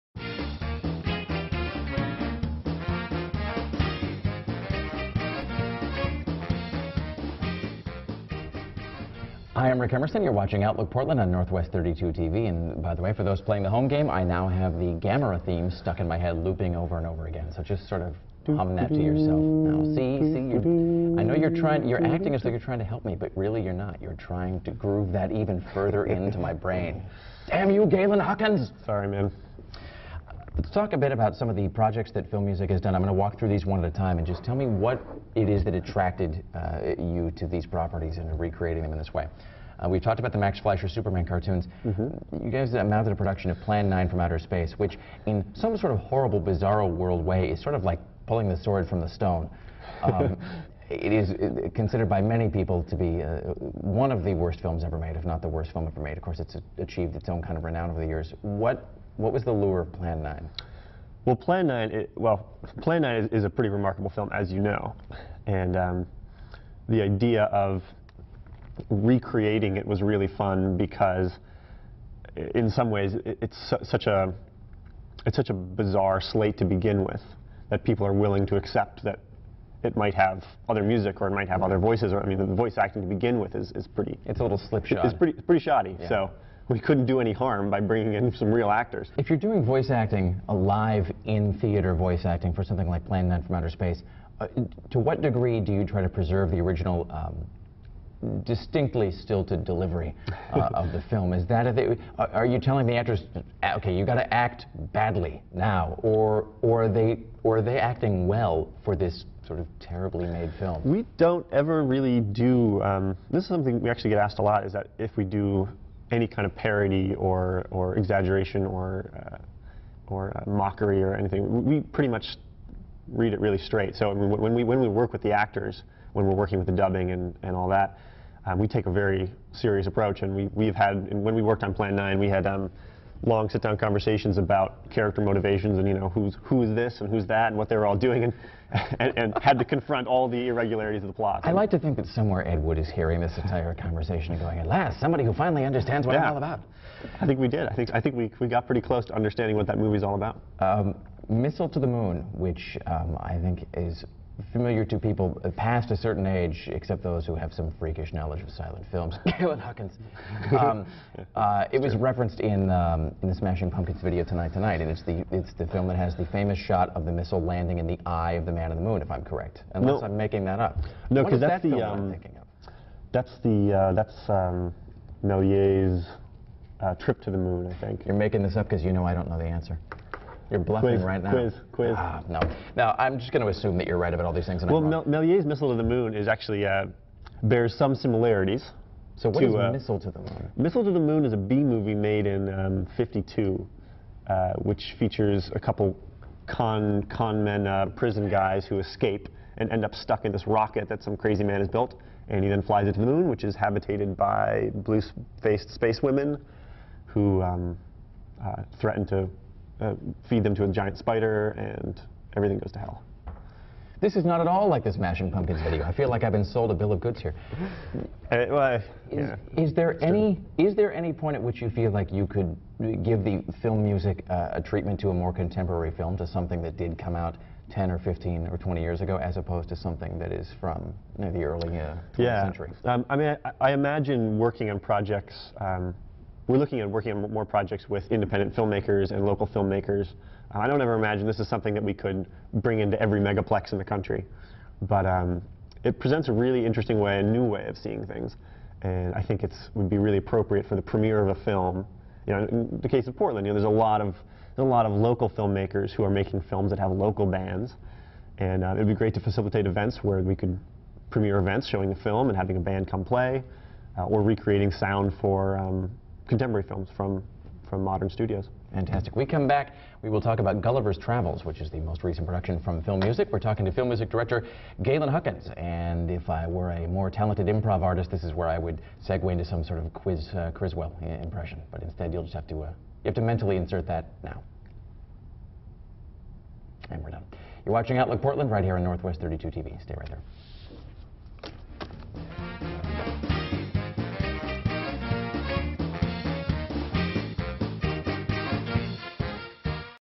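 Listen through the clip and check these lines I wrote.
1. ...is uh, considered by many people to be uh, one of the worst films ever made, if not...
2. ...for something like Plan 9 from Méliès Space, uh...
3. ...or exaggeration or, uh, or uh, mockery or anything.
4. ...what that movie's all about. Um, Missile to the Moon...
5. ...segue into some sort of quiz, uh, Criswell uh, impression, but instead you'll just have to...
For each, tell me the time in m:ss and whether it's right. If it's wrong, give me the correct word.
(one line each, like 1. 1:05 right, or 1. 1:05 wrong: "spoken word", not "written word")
1. 0:51 right
2. 1:32 wrong: "Outer", not "Méliès"
3. 1:57 right
4. 2:29 right
5. 4:39 right.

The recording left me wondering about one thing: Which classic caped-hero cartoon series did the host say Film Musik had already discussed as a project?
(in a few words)
Max Fleischer Superman.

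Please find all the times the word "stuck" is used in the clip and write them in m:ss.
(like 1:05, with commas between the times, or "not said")
0:15, 3:19.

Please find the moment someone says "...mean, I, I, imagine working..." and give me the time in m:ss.
3:53.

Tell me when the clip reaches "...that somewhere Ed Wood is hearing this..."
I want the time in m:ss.
2:21.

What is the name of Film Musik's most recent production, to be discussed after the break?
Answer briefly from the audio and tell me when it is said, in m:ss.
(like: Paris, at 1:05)
Gulliver's Travels, at 4:30.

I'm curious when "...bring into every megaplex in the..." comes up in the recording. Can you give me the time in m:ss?
4:02.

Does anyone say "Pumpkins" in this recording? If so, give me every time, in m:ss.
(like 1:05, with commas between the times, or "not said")
2:43, 3:35.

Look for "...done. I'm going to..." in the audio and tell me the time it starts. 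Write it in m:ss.
0:32.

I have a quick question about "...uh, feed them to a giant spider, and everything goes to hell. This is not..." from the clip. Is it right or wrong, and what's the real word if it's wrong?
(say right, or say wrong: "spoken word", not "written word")
right.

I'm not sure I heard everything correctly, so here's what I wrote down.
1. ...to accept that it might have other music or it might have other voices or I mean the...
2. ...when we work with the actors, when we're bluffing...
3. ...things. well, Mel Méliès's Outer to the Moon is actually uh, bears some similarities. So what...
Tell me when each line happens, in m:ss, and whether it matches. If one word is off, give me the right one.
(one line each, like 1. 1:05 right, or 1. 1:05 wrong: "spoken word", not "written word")
1. 1:18 right
2. 2:04 wrong: "working", not "bluffing"
3. 3:04 wrong: "Missile", not "Outer".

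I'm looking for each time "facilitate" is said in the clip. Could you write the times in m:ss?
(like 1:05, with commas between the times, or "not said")
4:19.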